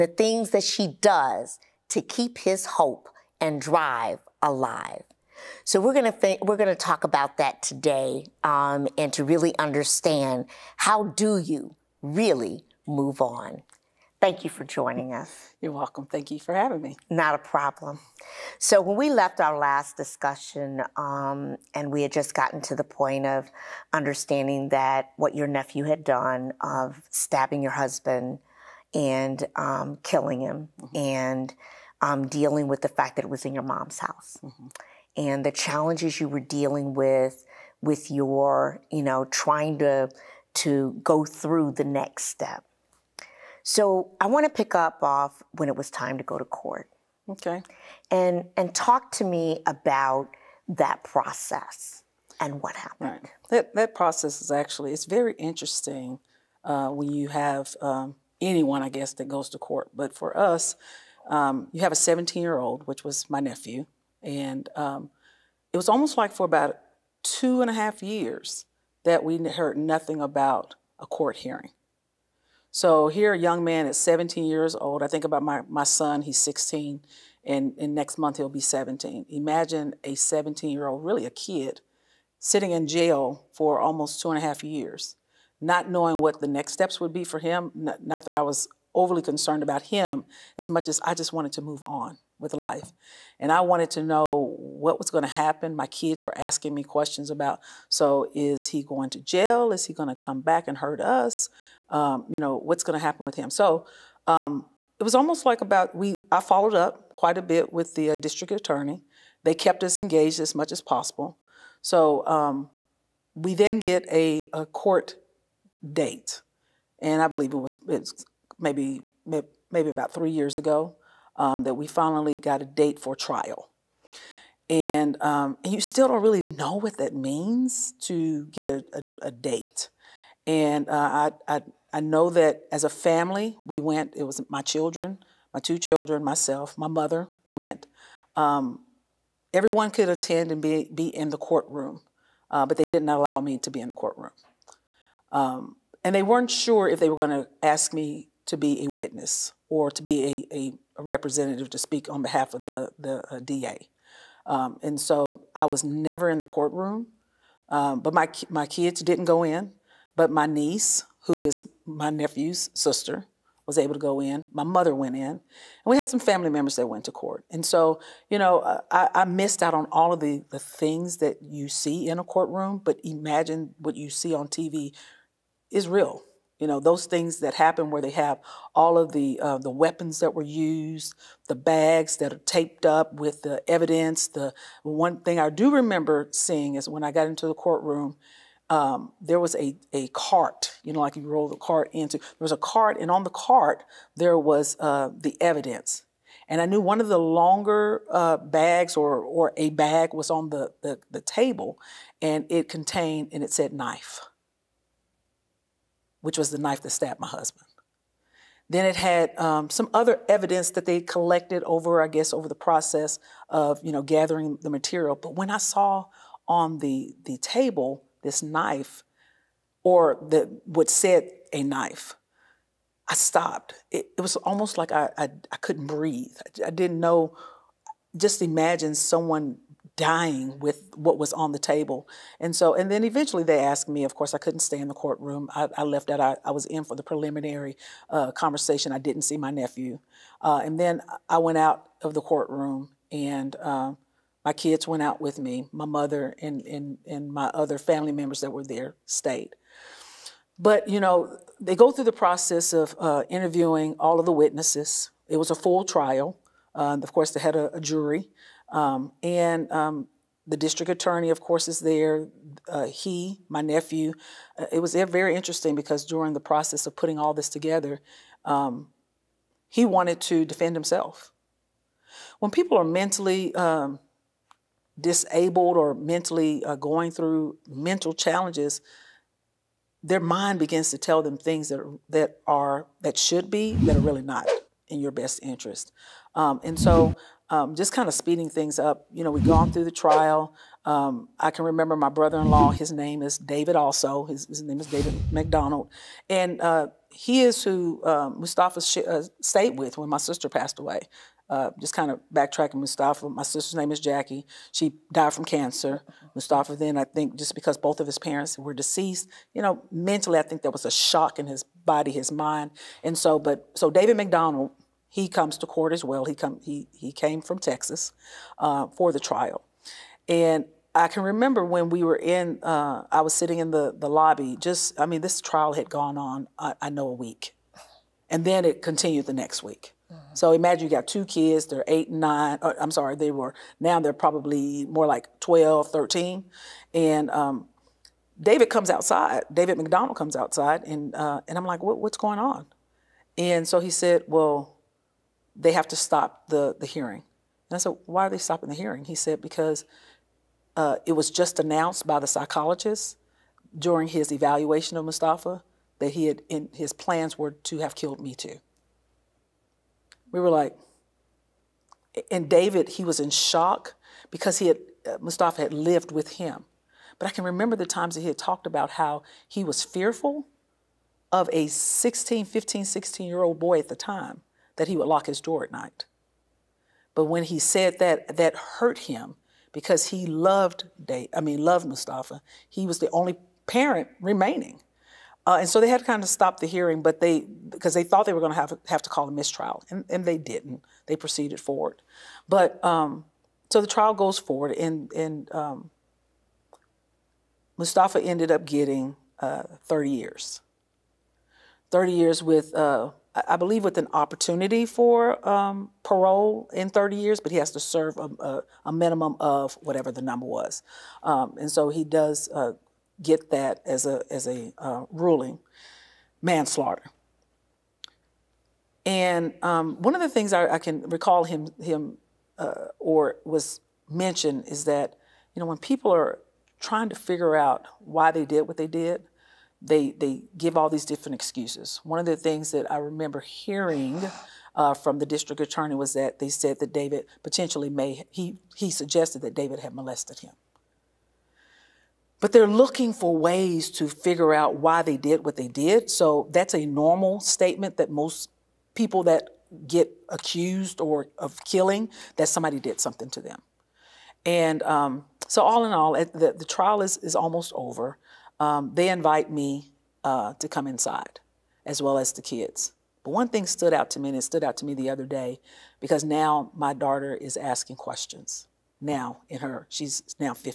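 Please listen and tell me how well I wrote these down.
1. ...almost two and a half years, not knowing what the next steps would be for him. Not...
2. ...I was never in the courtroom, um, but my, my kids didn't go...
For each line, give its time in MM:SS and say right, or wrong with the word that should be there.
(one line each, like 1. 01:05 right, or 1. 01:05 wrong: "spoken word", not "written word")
1. 01:23 right
2. 02:35 right.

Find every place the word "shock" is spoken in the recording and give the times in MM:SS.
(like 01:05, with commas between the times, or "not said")
05:10, 06:03.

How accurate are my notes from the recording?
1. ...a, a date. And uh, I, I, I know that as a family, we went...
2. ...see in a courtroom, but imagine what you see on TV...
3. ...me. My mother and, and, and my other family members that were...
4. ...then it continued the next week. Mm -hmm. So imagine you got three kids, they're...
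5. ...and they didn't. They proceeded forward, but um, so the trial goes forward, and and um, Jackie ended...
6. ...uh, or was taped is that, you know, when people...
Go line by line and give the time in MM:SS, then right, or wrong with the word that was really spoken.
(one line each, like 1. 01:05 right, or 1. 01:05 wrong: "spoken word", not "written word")
1. 02:08 right
2. 02:51 right
3. 04:05 right
4. 05:28 wrong: "two", not "three"
5. 06:30 wrong: "Mustafa", not "Jackie"
6. 07:02 wrong: "mentioned", not "taped".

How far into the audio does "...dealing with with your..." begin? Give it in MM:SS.
00:36.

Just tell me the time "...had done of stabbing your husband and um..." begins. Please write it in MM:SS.
00:25.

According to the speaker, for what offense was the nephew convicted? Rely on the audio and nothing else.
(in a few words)
manslaughter.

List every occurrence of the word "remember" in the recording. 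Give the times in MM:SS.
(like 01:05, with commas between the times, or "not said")
03:05, 04:51, 05:21, 06:07, 07:12.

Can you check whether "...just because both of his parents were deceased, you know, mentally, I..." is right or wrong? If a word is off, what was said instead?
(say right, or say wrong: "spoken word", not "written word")
right.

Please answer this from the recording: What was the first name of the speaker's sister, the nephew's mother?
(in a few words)
Jackie.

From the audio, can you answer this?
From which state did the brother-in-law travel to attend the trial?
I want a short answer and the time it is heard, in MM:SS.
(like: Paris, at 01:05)
Texas, at 05:17.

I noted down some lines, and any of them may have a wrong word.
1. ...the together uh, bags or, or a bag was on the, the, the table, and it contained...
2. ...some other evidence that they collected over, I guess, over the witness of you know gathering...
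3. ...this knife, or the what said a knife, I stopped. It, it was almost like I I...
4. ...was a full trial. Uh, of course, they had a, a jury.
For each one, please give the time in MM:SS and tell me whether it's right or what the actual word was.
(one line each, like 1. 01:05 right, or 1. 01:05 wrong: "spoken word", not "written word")
1. 03:17 wrong: "longer", not "together"
2. 03:29 wrong: "process", not "witness"
3. 03:38 right
4. 04:15 right.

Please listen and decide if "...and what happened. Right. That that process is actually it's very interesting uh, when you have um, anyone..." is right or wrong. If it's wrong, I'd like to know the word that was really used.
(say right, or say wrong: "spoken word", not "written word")
right.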